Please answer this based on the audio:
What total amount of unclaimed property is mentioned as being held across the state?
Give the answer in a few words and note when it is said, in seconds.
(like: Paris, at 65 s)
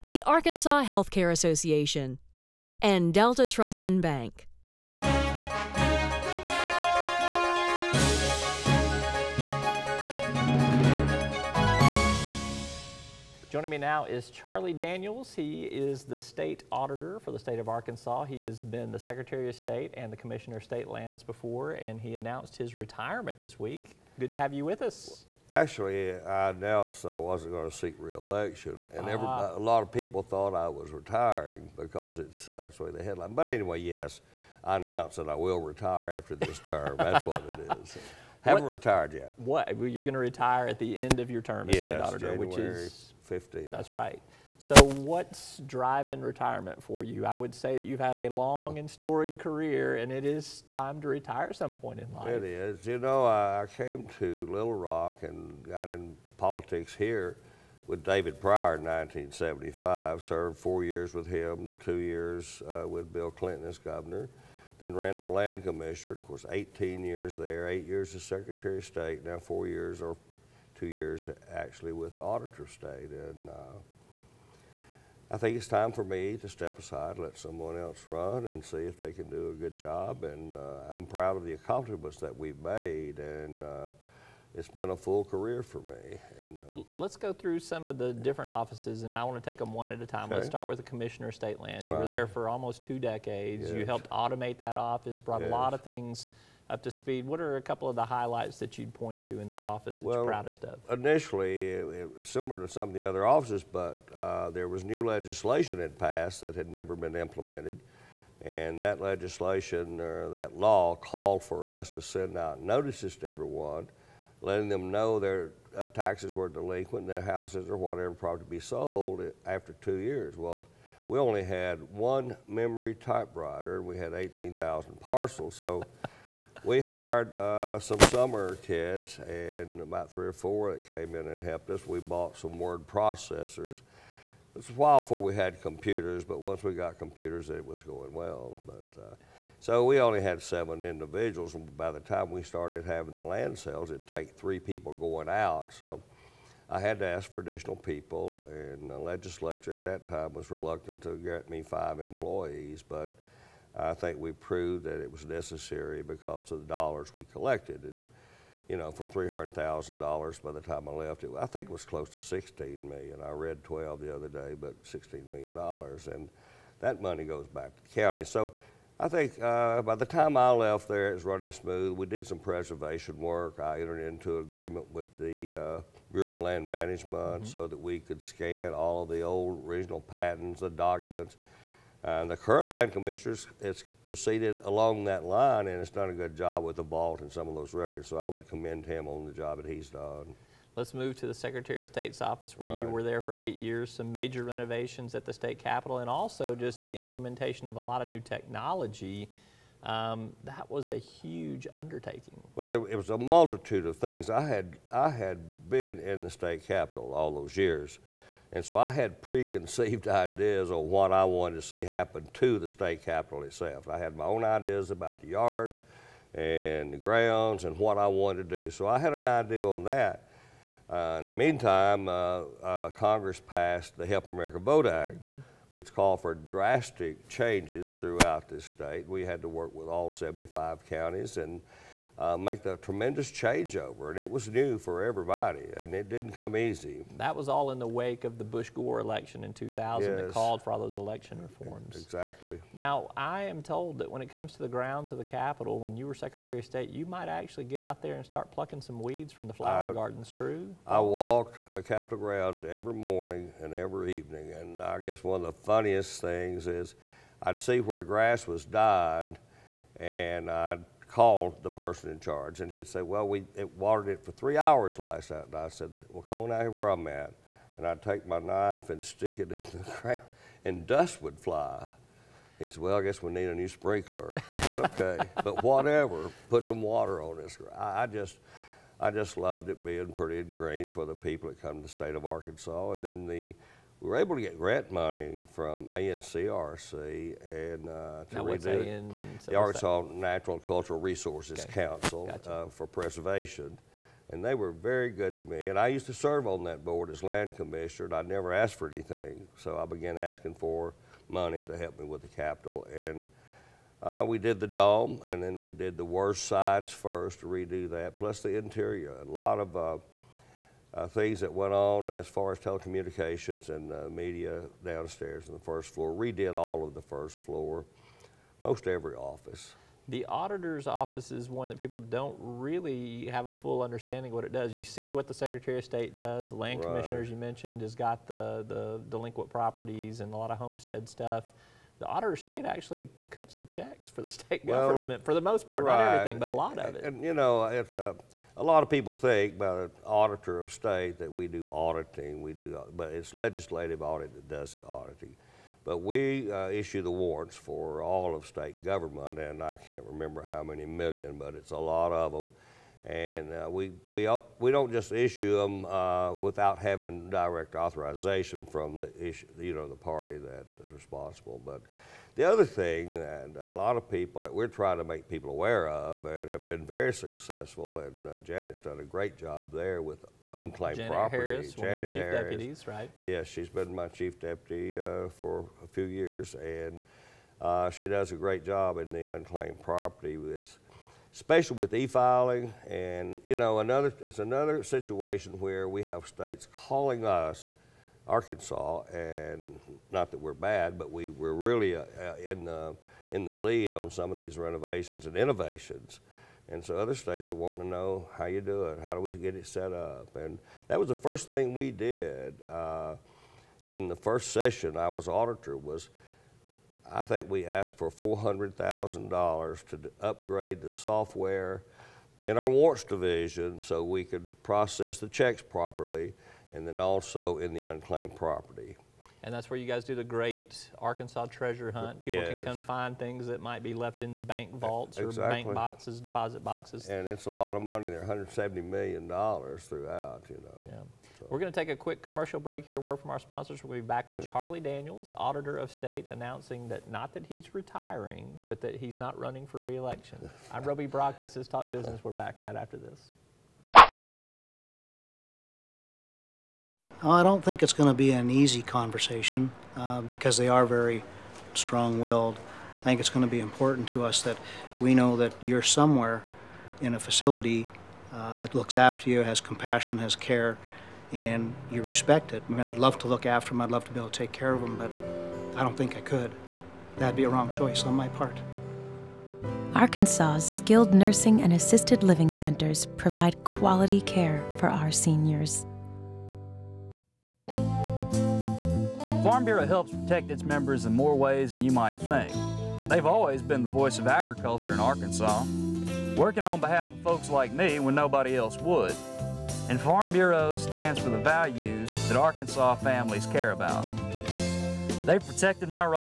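$170 million, at 428 s.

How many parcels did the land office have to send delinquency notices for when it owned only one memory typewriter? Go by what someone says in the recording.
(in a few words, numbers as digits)
18,000.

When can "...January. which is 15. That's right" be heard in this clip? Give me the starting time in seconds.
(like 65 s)
42 s.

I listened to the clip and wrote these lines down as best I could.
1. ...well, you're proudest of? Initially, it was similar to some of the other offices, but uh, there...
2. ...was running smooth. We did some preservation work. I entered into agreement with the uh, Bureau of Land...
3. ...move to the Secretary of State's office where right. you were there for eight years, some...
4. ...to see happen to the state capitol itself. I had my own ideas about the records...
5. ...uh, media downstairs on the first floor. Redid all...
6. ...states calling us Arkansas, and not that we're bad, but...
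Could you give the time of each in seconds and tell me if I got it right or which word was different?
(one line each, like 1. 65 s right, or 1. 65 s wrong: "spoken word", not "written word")
1. 100 s right
2. 171 s right
3. 190 s right
4. 211 s wrong: "yards", not "records"
5. 313 s right
6. 386 s right.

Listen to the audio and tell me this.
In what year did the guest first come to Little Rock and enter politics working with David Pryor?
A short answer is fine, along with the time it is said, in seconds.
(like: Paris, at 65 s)
1975, at 58 s.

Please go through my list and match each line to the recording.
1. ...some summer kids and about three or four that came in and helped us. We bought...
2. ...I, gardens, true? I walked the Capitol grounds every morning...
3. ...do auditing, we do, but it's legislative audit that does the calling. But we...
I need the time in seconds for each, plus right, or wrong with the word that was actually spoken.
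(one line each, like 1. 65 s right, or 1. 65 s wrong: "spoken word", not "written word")
1. 127 s right
2. 249 s right
3. 341 s wrong: "auditing", not "calling".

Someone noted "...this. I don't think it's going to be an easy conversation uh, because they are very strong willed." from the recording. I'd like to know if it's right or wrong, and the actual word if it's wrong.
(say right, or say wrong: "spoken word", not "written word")
right.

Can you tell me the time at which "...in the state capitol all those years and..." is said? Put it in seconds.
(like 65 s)
205 s.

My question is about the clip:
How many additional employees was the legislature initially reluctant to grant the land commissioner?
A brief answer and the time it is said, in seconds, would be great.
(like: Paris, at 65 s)
5, at 151 s.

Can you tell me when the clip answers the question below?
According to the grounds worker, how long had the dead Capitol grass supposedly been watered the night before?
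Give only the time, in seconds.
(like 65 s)
264 s.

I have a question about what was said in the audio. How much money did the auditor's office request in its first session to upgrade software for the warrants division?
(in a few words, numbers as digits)
$400,000.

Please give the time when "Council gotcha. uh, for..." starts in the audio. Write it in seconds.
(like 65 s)
291 s.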